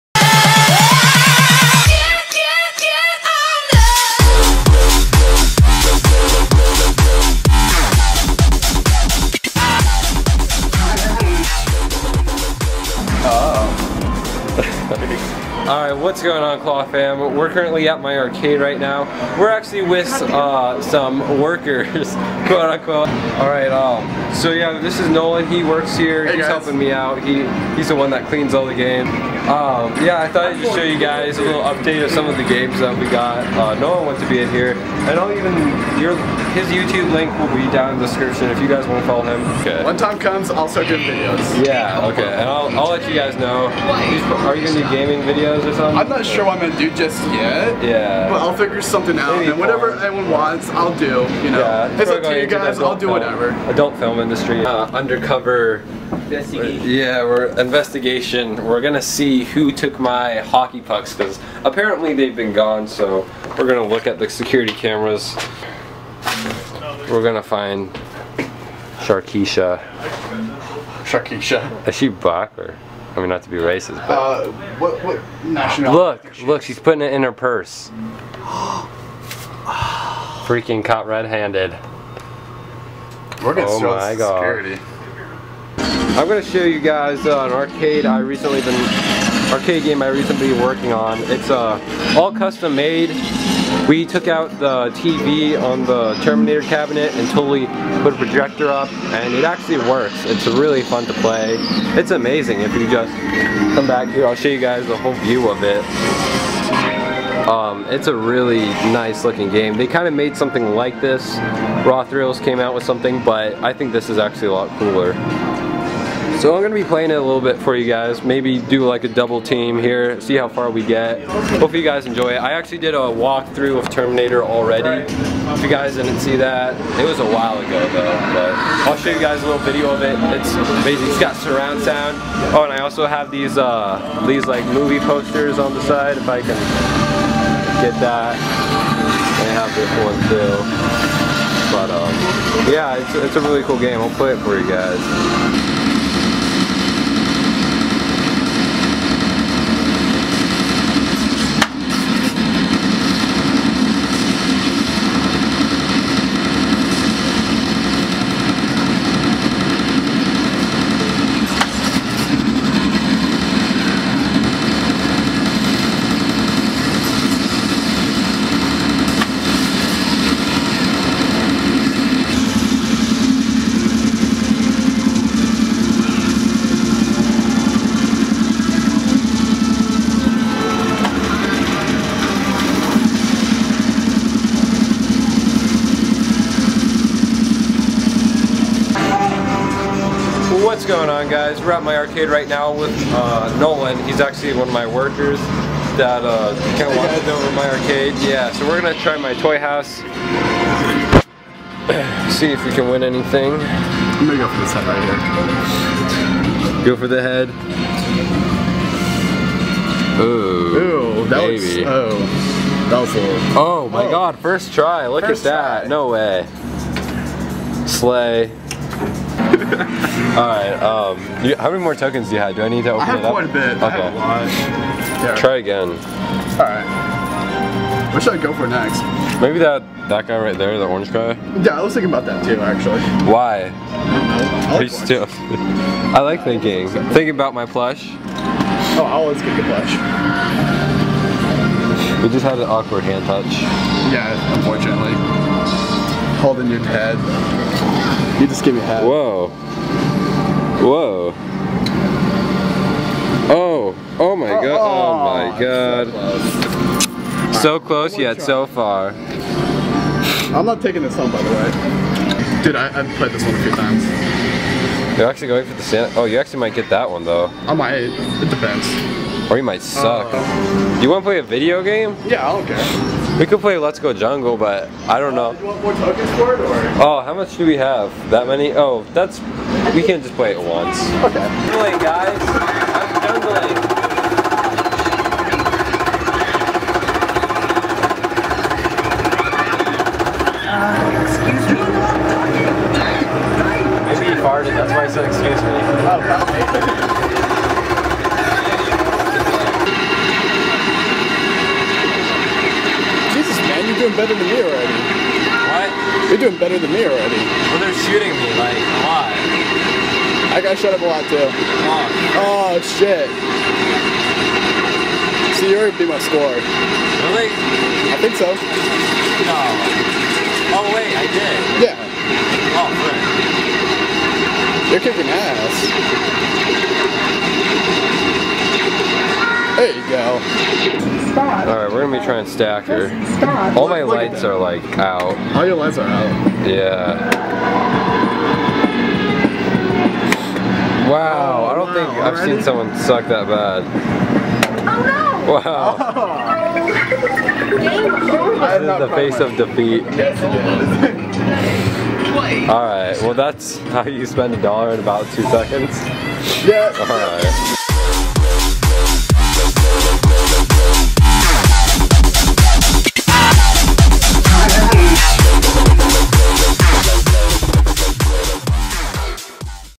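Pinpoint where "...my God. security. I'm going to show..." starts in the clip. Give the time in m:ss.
1:23.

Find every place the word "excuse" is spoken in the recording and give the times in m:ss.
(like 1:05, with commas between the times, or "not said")
4:51, 4:55.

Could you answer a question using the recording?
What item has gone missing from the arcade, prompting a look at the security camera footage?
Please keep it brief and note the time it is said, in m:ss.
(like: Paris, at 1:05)
hockey pucks, at 1:00.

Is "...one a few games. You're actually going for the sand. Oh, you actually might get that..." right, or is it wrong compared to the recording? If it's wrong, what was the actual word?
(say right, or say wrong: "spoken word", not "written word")
wrong: "times", not "games".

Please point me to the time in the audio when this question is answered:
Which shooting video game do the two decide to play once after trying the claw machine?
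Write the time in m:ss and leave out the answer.
4:33.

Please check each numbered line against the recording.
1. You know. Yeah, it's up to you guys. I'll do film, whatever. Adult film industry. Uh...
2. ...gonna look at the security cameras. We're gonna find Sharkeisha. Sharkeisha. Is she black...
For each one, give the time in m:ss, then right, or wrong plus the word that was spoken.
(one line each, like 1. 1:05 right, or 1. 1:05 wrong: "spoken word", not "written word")
1. 0:51 right
2. 1:03 right.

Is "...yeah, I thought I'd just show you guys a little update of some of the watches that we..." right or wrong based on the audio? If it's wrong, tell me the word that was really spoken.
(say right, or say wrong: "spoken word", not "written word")
wrong: "games", not "watches".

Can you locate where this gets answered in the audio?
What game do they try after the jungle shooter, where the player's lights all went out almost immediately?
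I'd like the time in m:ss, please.
5:32.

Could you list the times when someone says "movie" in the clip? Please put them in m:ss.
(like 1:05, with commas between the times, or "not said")
2:14.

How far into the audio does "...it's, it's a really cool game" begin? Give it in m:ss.
2:22.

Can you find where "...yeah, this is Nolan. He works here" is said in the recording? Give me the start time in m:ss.
0:24.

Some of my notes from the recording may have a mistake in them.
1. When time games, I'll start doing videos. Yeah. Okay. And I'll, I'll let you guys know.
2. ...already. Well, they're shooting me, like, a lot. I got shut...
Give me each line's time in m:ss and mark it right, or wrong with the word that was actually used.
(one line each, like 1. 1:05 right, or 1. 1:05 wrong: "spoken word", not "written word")
1. 0:39 wrong: "comes", not "games"
2. 5:07 right.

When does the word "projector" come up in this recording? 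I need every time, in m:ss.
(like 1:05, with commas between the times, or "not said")
1:38.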